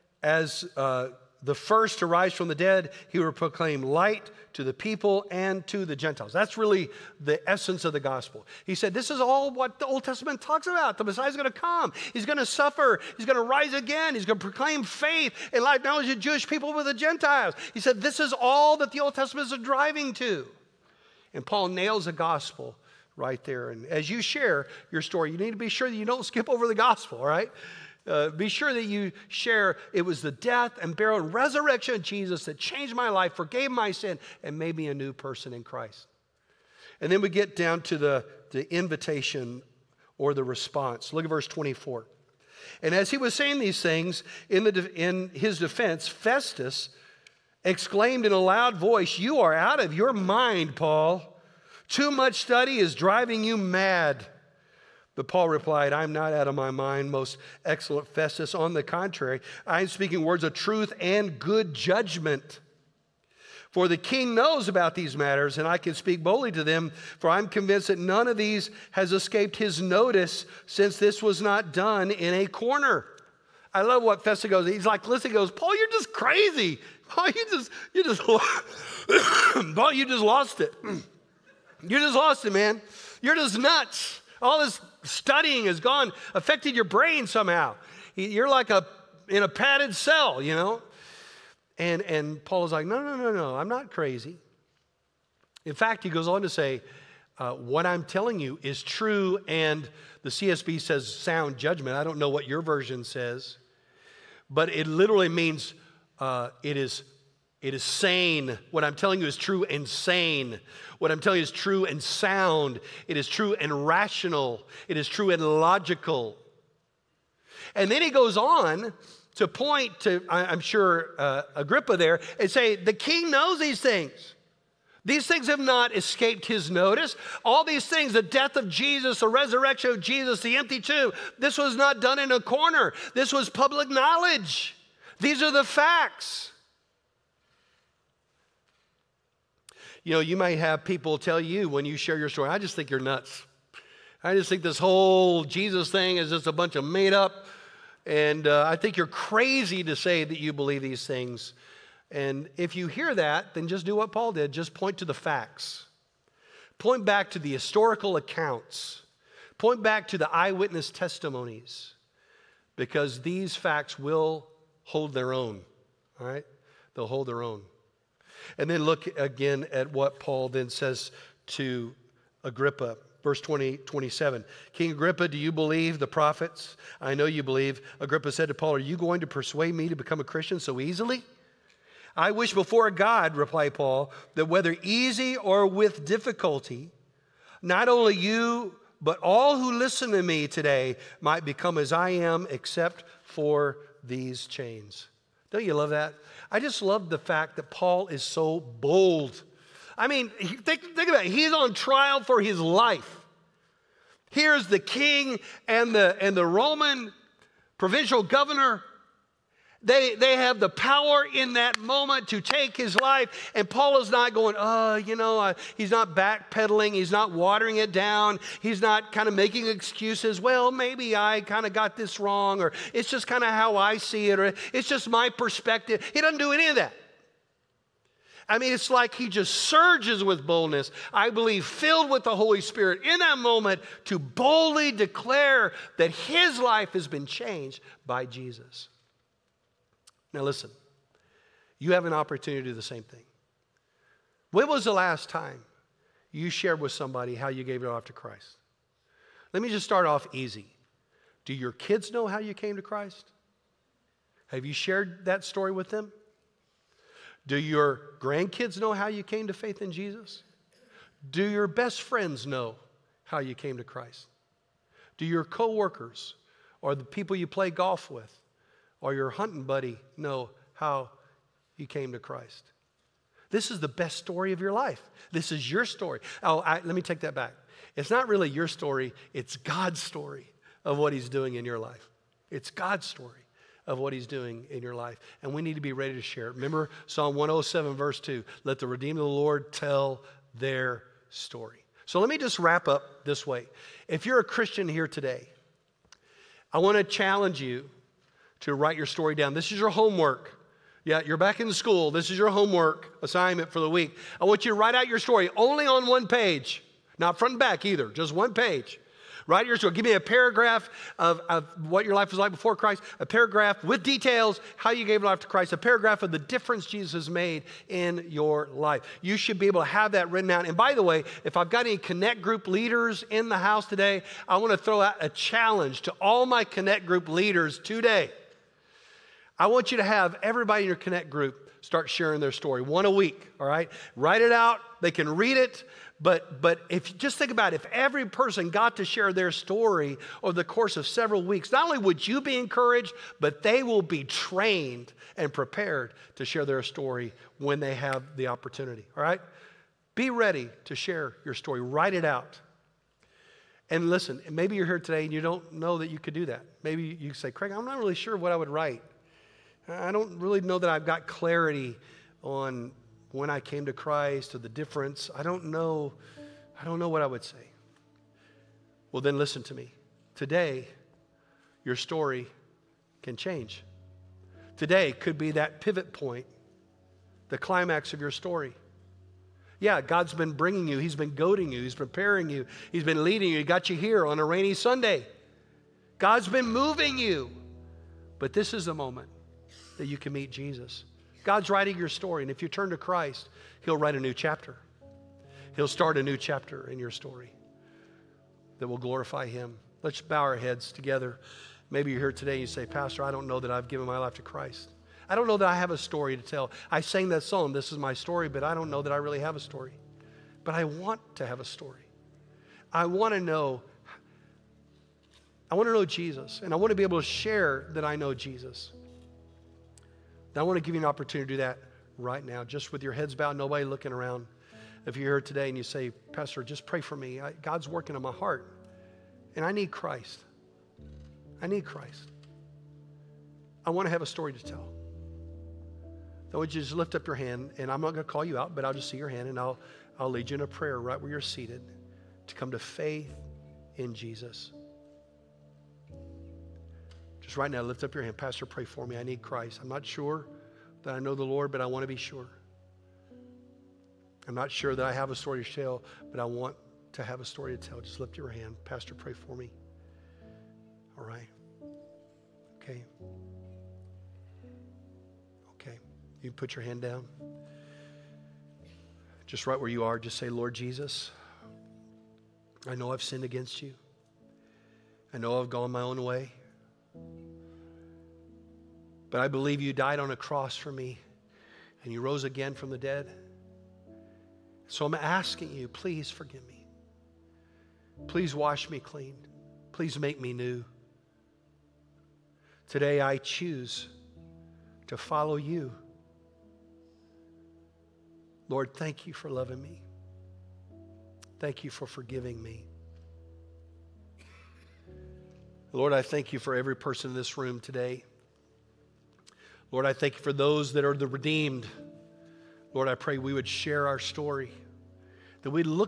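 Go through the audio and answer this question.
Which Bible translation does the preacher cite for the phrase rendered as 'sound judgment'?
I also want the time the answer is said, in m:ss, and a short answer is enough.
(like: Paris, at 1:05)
CSB, at 1:40.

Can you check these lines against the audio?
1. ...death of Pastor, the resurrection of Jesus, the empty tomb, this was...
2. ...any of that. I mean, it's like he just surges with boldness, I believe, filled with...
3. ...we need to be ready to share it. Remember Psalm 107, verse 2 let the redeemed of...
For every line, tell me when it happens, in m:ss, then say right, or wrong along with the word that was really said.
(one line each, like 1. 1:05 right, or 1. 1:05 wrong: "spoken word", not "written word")
1. 2:08 wrong: "Jesus", not "Pastor"
2. 3:46 right
3. 4:45 right.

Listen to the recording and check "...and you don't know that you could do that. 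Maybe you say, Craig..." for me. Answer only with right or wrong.
right.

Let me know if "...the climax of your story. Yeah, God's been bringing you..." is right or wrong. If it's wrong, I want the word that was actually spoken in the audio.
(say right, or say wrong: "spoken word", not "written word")
right.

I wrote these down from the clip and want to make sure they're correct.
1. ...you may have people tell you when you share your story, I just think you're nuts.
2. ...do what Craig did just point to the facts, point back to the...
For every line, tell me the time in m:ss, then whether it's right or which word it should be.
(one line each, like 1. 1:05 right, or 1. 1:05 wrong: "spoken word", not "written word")
1. 2:20 right
2. 2:33 wrong: "Paul", not "Craig".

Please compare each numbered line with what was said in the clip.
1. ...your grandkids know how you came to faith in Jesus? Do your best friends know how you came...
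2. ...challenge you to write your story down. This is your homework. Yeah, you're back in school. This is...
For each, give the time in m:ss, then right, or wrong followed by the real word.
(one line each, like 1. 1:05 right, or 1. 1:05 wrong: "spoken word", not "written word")
1. 4:17 right
2. 4:57 right.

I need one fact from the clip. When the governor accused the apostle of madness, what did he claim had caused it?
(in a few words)
Too much study.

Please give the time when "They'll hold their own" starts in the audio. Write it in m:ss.
2:46.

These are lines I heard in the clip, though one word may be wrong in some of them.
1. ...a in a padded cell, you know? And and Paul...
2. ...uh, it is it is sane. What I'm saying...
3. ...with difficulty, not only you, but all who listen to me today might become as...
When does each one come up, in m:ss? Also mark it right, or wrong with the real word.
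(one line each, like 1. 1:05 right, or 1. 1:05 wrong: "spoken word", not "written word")
1. 1:28 right
2. 1:46 wrong: "telling", not "saying"
3. 3:05 right.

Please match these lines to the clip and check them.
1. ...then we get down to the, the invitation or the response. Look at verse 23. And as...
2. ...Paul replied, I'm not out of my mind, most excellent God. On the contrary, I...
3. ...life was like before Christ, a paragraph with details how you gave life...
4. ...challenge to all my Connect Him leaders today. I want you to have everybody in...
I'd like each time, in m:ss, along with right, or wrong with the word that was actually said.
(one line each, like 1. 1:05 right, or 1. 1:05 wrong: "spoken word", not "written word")
1. 0:37 wrong: "24", not "23"
2. 0:55 wrong: "Festus", not "God"
3. 5:12 right
4. 5:25 wrong: "Group", not "Him".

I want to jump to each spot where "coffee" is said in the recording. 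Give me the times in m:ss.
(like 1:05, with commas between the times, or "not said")
not said.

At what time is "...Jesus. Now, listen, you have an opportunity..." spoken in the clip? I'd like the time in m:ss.
3:58.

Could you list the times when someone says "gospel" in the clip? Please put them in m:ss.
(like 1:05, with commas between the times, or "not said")
0:07, 0:22, 0:26.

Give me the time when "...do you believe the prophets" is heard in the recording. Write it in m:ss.
2:55.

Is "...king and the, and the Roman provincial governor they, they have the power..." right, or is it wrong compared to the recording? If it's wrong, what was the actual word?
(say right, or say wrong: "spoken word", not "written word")
right.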